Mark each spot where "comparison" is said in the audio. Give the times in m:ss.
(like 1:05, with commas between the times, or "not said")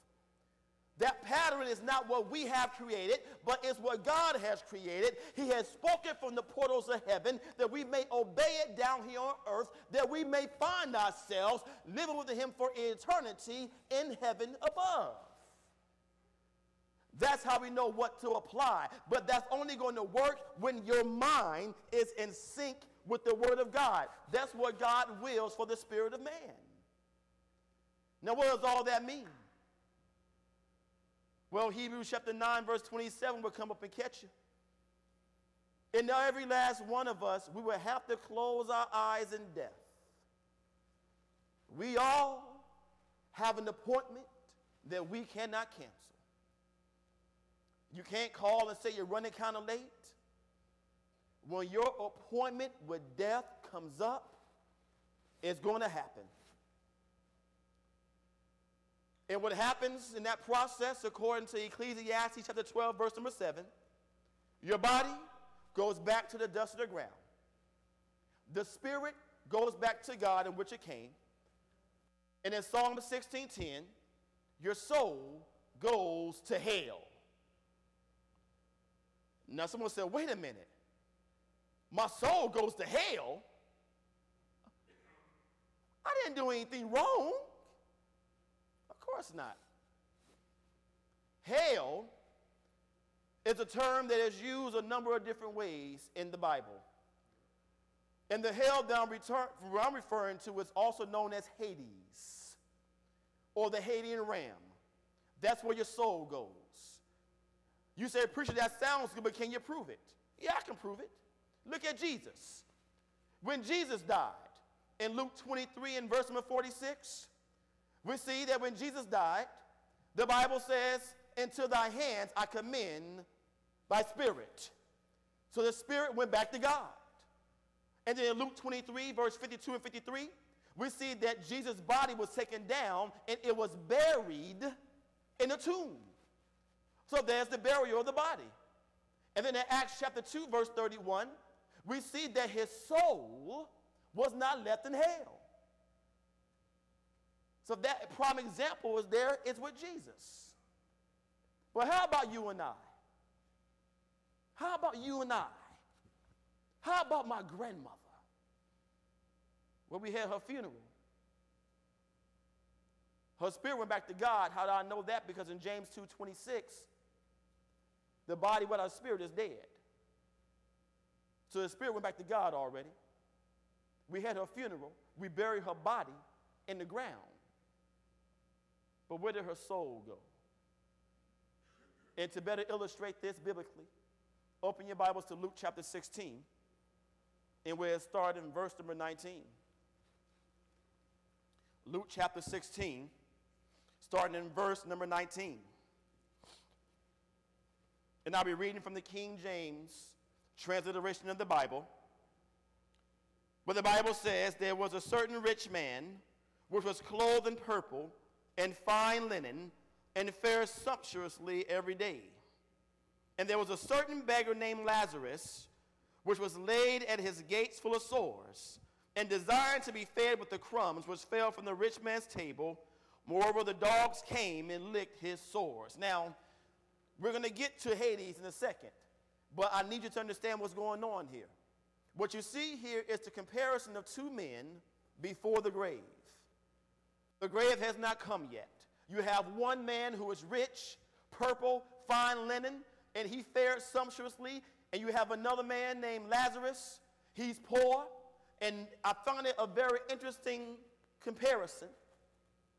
3:53, 4:11.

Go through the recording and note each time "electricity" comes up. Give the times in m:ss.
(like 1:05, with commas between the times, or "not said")
not said.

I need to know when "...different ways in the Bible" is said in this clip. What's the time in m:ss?
1:35.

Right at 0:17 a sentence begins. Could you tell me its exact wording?
That's how we know what to apply.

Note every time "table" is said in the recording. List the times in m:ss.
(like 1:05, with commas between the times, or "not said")
3:42.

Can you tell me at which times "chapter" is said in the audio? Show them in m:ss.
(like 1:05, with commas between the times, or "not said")
0:32, 1:02, 2:19, 3:05, 3:12.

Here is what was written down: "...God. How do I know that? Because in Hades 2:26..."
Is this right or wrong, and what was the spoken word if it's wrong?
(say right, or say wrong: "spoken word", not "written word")
wrong: "James", not "Hades".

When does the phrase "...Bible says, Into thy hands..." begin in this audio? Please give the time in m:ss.
2:00.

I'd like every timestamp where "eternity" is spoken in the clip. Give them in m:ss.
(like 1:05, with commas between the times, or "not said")
0:12.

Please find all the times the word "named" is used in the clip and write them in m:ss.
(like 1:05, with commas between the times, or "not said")
3:34, 4:06.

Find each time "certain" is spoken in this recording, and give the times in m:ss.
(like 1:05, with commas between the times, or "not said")
3:25, 3:33.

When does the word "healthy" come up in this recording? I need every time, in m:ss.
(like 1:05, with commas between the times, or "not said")
not said.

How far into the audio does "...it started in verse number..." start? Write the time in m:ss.
3:07.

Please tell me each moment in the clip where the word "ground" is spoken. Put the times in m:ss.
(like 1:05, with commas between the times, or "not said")
1:06, 2:56.